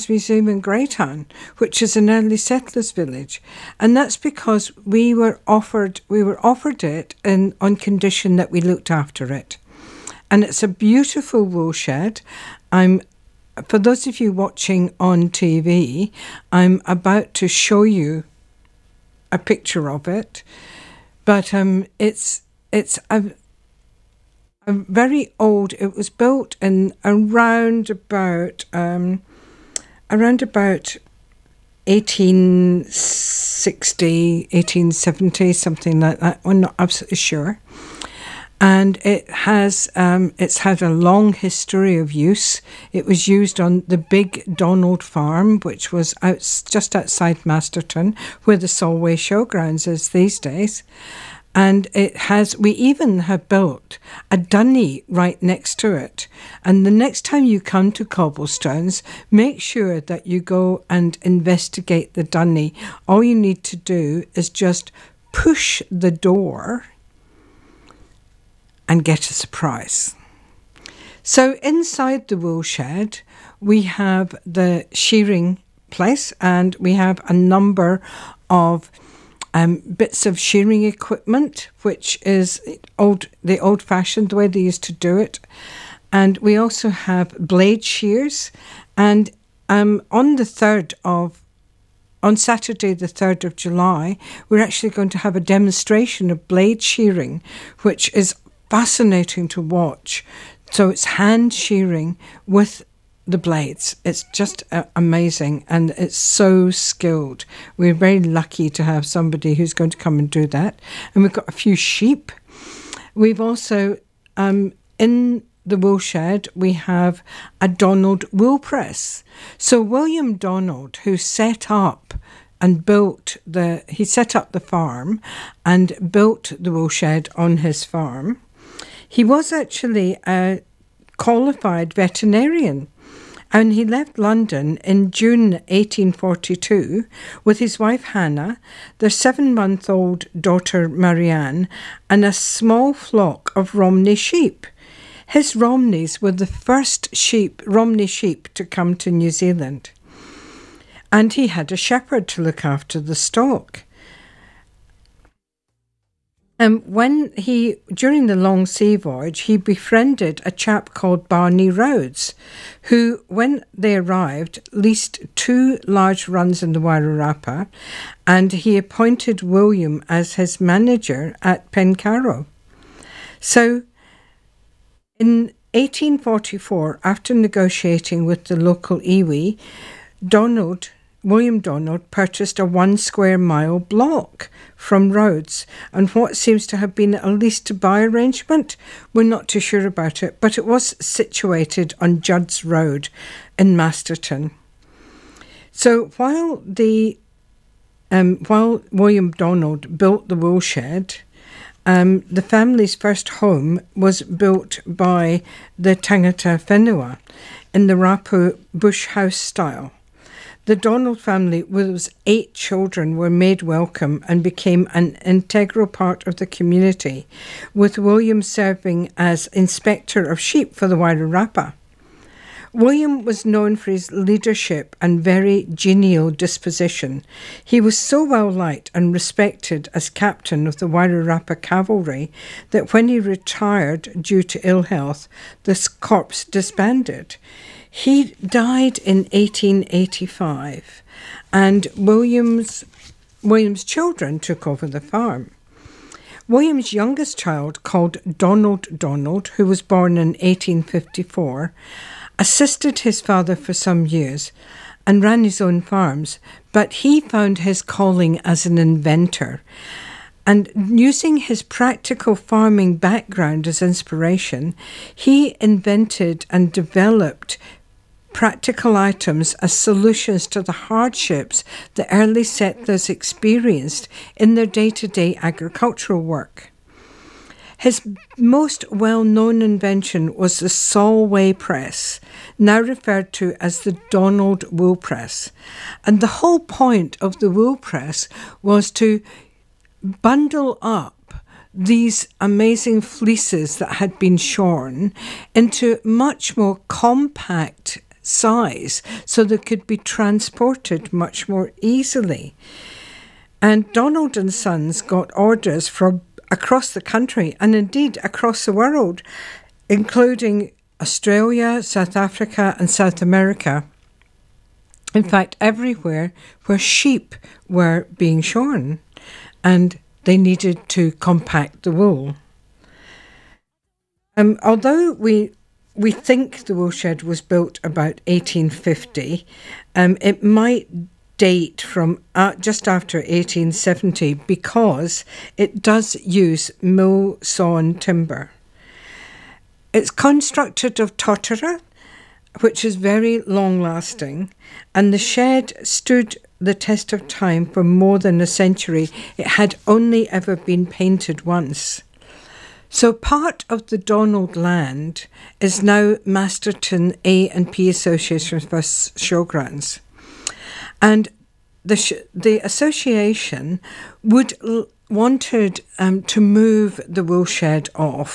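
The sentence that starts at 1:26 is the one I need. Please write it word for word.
And we also have blade shears.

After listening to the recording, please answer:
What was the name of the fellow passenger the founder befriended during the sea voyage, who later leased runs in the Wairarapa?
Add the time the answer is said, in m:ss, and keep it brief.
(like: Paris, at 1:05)
Barney Rhodes, at 2:41.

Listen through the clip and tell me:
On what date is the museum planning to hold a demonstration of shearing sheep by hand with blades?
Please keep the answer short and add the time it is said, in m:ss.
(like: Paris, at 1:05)
Saturday, 3 July, at 1:32.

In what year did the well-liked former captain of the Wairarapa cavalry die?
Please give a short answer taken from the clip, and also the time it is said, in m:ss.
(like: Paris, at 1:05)
1885, at 3:59.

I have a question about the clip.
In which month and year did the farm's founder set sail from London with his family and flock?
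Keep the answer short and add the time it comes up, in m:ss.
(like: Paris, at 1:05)
June 1842, at 2:15.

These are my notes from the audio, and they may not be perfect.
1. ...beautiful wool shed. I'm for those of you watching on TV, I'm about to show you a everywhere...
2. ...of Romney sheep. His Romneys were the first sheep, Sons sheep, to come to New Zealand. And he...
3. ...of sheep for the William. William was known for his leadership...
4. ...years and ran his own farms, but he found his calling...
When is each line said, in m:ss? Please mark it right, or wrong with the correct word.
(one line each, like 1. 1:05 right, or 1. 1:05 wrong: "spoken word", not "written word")
1. 0:10 wrong: "picture", not "everywhere"
2. 2:23 wrong: "Romney", not "Sons"
3. 3:40 wrong: "Wairarapa", not "William"
4. 4:14 right.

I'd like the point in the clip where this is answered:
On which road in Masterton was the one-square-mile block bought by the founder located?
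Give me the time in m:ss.
3:12.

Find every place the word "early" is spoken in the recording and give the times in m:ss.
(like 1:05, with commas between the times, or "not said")
0:02, 4:32.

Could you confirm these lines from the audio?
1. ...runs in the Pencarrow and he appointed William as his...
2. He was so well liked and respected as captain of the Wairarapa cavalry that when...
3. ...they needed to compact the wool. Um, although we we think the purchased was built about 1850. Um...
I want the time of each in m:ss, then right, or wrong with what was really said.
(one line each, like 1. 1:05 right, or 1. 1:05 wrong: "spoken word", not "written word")
1. 2:46 wrong: "Wairarapa", not "Pencarrow"
2. 3:47 right
3. 5:20 wrong: "woolshed", not "purchased".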